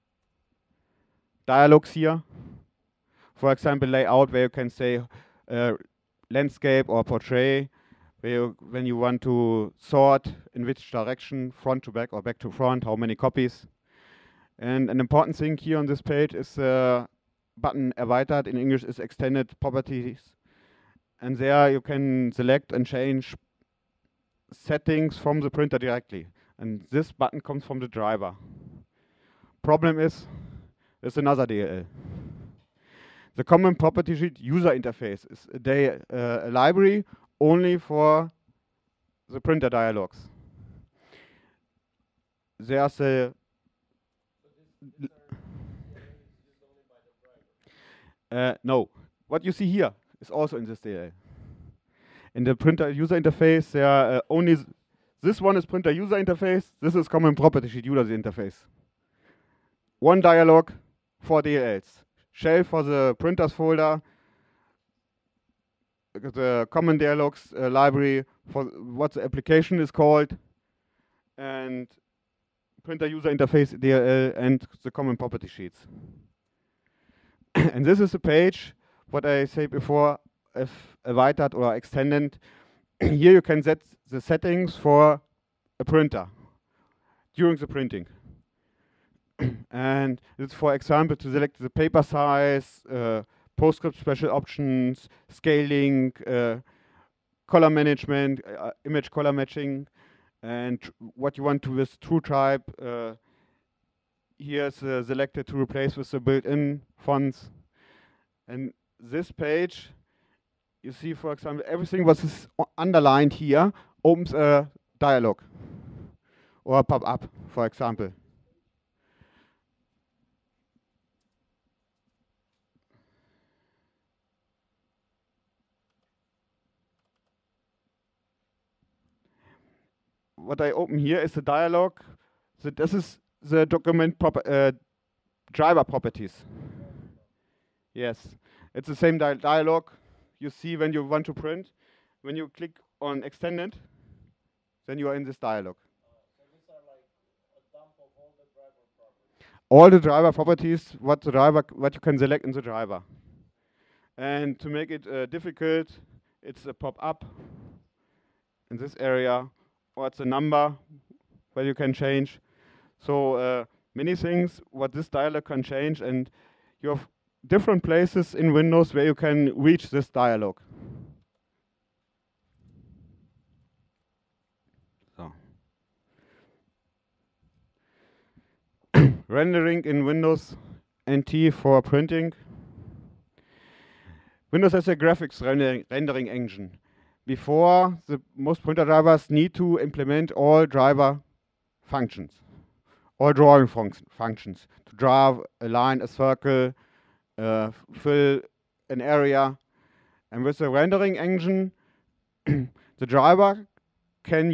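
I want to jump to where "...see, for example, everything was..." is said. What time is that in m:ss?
1:50.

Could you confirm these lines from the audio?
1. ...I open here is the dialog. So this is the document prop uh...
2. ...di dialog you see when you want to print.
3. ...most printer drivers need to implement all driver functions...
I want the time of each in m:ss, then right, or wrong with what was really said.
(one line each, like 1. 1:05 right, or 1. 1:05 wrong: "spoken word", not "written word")
1. 2:10 right
2. 2:19 right
3. 3:08 right.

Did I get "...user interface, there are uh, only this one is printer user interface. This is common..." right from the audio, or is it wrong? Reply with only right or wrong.
right.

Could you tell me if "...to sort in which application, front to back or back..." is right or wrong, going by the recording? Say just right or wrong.
wrong.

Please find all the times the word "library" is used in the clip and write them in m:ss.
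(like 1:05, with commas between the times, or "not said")
0:36, 1:07.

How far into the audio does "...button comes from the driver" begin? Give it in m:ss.
0:27.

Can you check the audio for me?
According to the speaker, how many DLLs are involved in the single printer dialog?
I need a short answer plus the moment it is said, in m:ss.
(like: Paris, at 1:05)
4, at 1:01.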